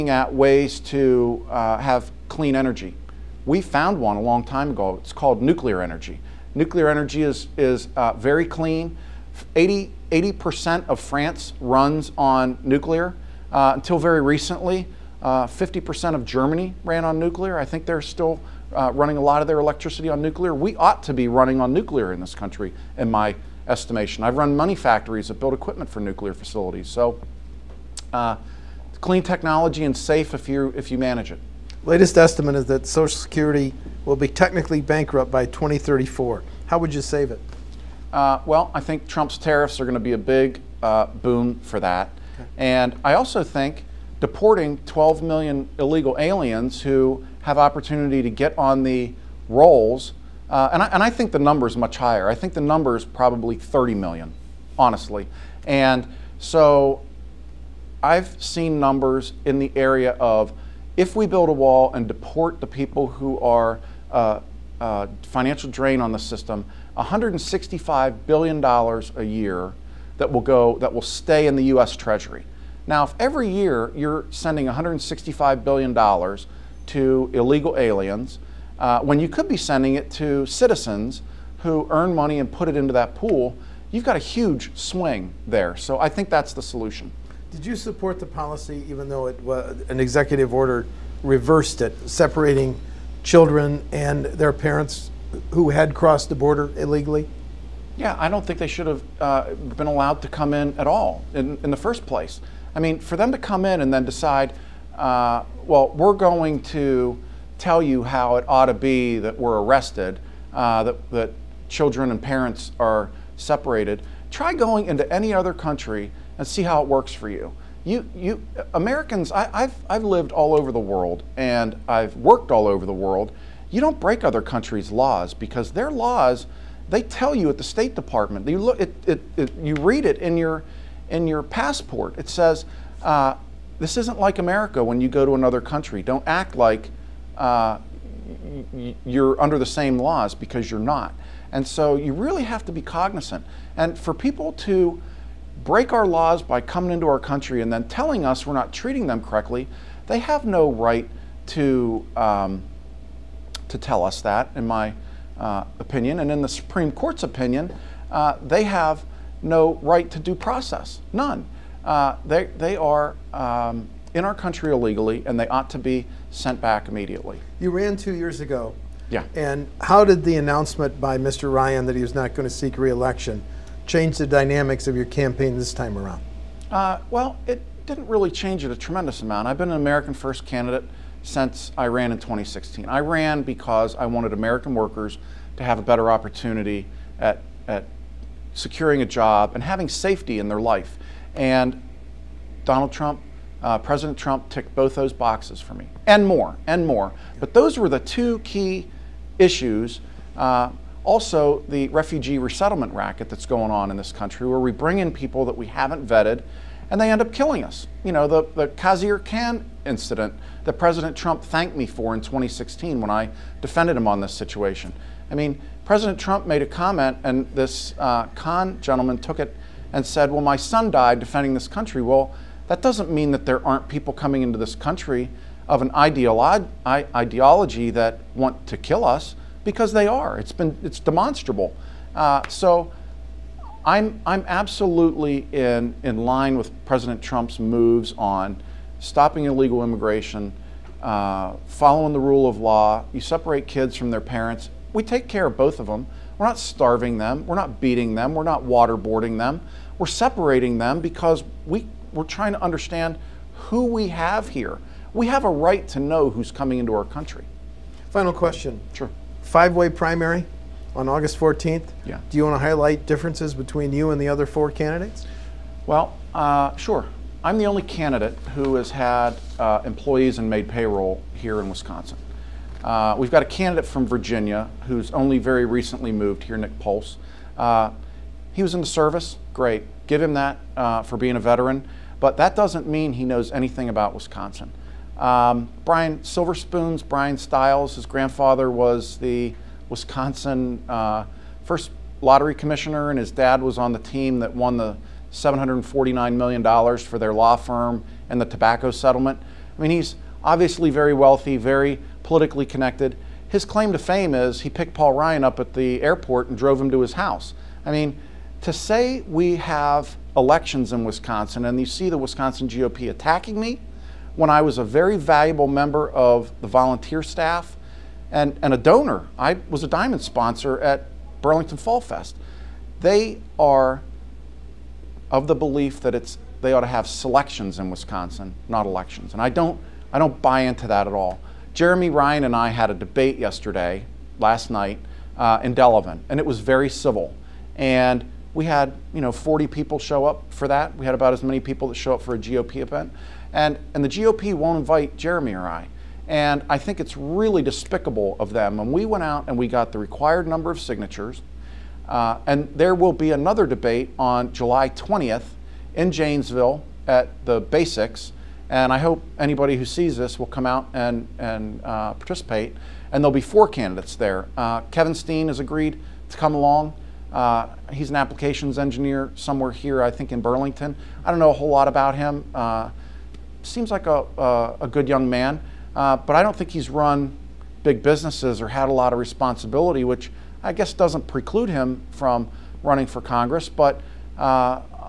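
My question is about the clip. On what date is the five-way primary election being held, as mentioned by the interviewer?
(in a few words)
August 14.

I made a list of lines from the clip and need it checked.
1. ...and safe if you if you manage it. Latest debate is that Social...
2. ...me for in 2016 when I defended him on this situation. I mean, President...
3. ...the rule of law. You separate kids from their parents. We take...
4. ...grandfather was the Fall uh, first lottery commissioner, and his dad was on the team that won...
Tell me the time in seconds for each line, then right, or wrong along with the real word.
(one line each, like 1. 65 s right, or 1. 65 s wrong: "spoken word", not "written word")
1. 29 s wrong: "estimate", not "debate"
2. 211 s right
3. 242 s right
4. 288 s wrong: "Wisconsin", not "Fall".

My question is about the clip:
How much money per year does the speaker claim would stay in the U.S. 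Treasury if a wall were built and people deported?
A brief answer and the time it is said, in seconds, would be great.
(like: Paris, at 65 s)
$165 billion, at 66 s.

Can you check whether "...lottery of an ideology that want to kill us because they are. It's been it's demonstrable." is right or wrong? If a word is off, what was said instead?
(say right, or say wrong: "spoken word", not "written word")
wrong: "country", not "lottery".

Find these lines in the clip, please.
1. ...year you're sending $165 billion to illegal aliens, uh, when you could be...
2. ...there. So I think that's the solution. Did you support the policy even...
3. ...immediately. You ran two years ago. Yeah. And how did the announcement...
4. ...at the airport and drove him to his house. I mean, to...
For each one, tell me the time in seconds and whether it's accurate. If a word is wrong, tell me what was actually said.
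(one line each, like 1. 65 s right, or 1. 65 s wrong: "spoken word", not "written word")
1. 73 s right
2. 85 s right
3. 166 s right
4. 305 s right.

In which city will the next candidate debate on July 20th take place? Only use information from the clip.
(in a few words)
Janesville.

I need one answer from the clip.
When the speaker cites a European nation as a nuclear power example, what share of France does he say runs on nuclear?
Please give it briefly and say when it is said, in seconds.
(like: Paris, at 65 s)
80%, at 10 s.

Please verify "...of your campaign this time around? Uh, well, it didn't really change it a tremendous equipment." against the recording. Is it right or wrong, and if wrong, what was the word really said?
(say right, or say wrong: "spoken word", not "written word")
wrong: "amount", not "equipment".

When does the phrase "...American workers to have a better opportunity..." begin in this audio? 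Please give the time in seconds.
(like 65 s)
184 s.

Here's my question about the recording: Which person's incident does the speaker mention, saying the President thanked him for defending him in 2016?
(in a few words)
Khizr Khan.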